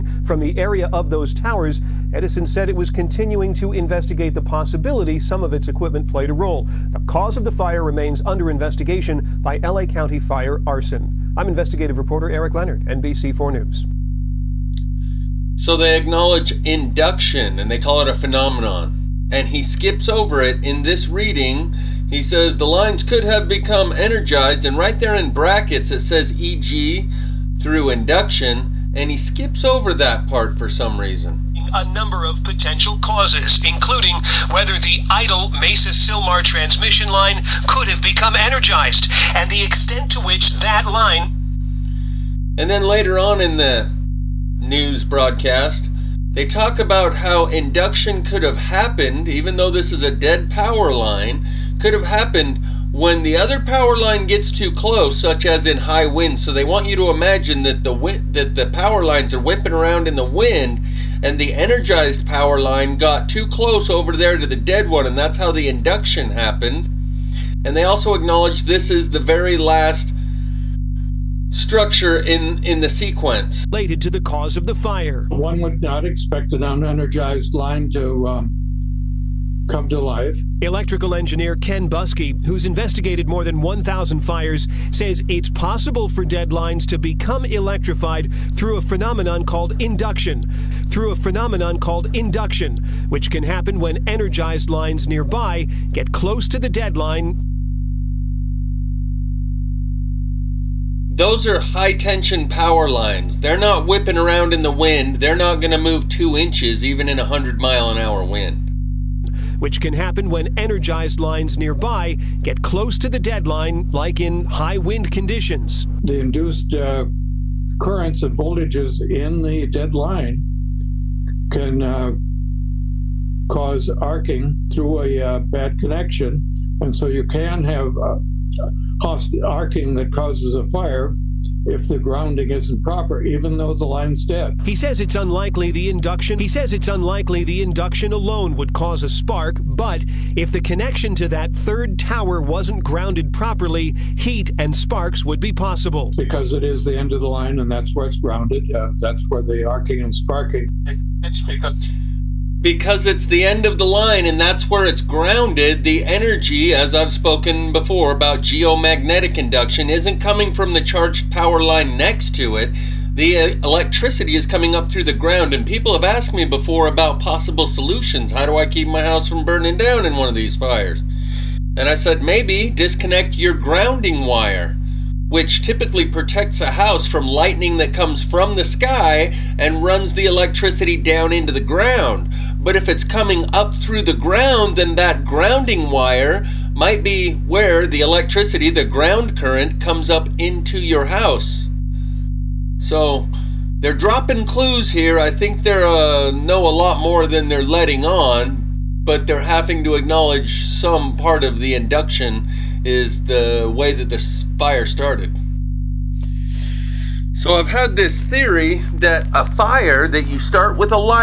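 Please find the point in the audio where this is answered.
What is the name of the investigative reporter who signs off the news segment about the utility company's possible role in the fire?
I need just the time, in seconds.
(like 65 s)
12 s.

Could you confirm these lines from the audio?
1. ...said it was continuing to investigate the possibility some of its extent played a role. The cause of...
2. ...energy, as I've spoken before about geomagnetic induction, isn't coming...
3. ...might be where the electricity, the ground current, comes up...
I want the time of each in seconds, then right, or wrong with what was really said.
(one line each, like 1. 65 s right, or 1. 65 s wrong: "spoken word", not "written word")
1. 2 s wrong: "equipment", not "extent"
2. 156 s right
3. 186 s right.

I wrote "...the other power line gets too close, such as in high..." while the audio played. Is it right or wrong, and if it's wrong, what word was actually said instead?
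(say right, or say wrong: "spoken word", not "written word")
right.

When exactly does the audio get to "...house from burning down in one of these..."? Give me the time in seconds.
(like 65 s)
169 s.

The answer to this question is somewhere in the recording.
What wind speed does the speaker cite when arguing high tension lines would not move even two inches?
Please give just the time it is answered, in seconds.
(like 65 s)
107 s.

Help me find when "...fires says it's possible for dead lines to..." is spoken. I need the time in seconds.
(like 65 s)
84 s.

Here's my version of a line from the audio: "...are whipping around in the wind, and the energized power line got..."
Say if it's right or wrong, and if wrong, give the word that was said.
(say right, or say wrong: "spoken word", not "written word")
right.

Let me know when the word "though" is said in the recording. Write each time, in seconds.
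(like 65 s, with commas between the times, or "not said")
49 s, 133 s.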